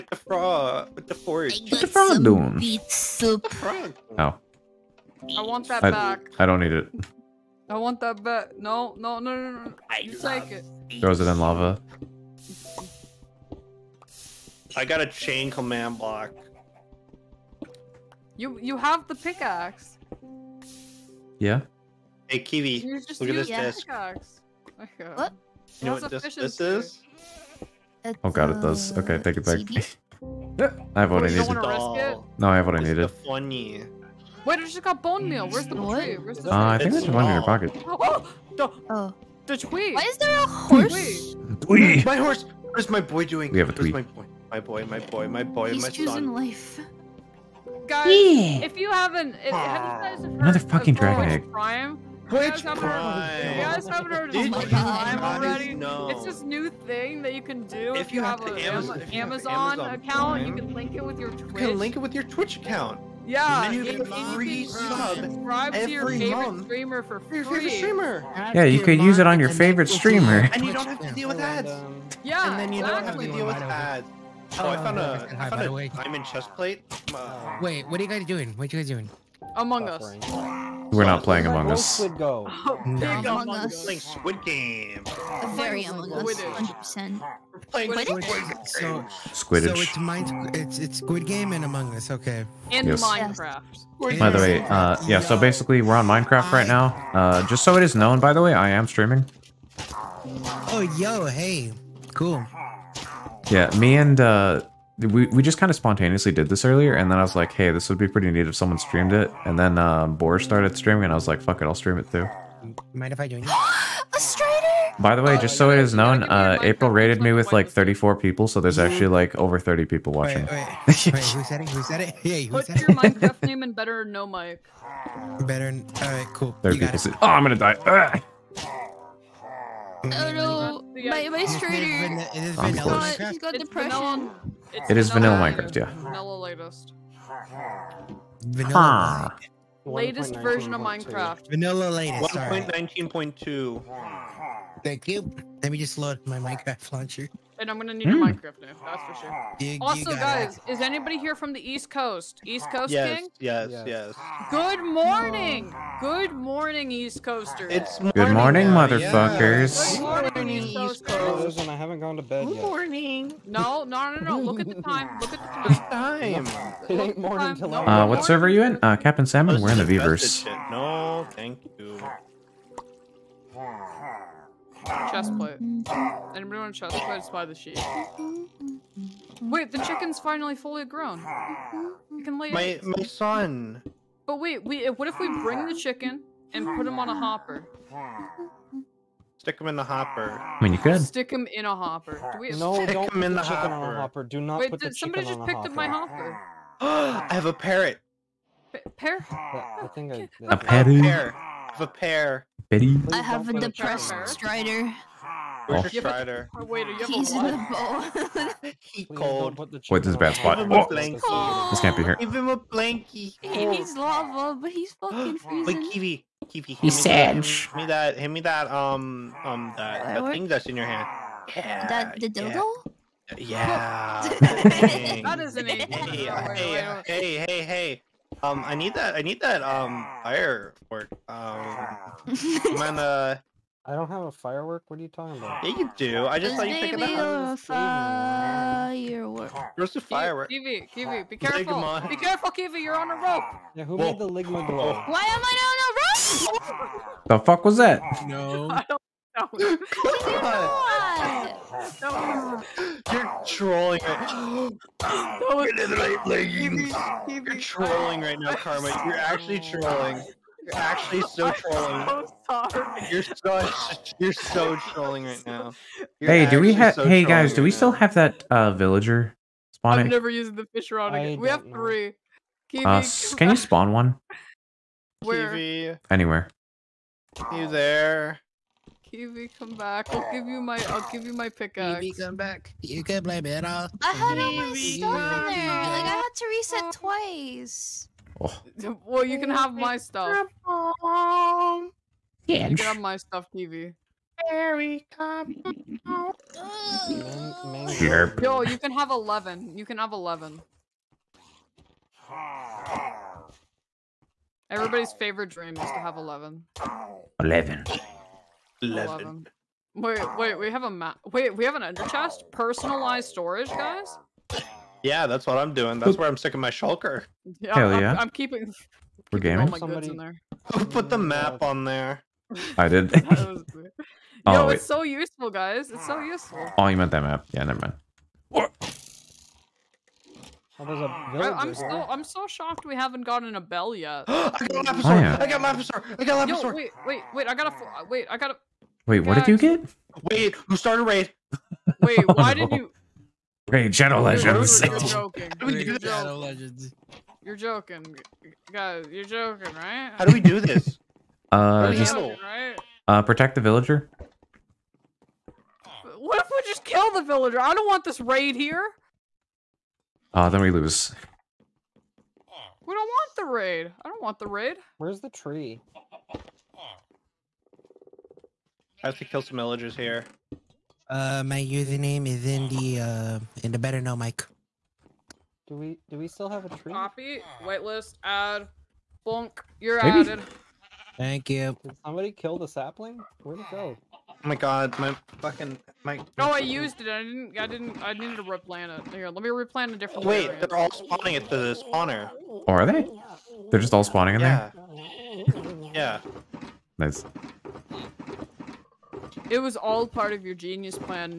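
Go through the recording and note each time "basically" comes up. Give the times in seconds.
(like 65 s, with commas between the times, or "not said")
95 s.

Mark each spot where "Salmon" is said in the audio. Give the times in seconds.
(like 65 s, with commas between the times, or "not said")
169 s.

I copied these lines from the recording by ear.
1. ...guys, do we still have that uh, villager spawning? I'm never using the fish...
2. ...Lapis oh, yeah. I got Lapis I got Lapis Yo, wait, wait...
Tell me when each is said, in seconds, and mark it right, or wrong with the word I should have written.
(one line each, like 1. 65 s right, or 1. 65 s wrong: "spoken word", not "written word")
1. 267 s right
2. 334 s right.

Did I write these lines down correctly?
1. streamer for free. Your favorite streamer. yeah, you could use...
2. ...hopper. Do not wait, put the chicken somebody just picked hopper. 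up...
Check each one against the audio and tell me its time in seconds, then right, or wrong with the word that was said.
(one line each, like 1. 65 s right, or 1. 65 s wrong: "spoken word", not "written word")
1. 66 s right
2. 194 s right.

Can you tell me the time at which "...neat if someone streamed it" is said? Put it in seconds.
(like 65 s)
108 s.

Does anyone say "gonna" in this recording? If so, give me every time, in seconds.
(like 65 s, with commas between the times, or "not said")
127 s, 147 s, 232 s.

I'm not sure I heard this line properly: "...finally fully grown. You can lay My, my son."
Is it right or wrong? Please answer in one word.
right.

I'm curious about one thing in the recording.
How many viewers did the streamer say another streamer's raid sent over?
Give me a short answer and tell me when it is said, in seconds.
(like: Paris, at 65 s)
34, at 117 s.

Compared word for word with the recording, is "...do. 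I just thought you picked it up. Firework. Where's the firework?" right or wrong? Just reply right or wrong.
right.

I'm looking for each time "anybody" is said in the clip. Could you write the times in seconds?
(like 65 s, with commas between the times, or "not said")
150 s, 175 s.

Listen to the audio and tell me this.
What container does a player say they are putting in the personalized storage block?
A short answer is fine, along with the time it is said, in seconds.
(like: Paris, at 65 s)
shulker, at 316 s.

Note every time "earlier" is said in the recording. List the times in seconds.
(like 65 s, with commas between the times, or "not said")
106 s.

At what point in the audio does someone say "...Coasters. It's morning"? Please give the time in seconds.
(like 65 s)
157 s.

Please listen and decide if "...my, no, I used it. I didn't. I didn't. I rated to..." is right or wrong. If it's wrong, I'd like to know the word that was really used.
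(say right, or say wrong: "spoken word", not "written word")
wrong: "needed", not "rated".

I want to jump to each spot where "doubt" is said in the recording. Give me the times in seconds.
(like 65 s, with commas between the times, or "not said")
not said.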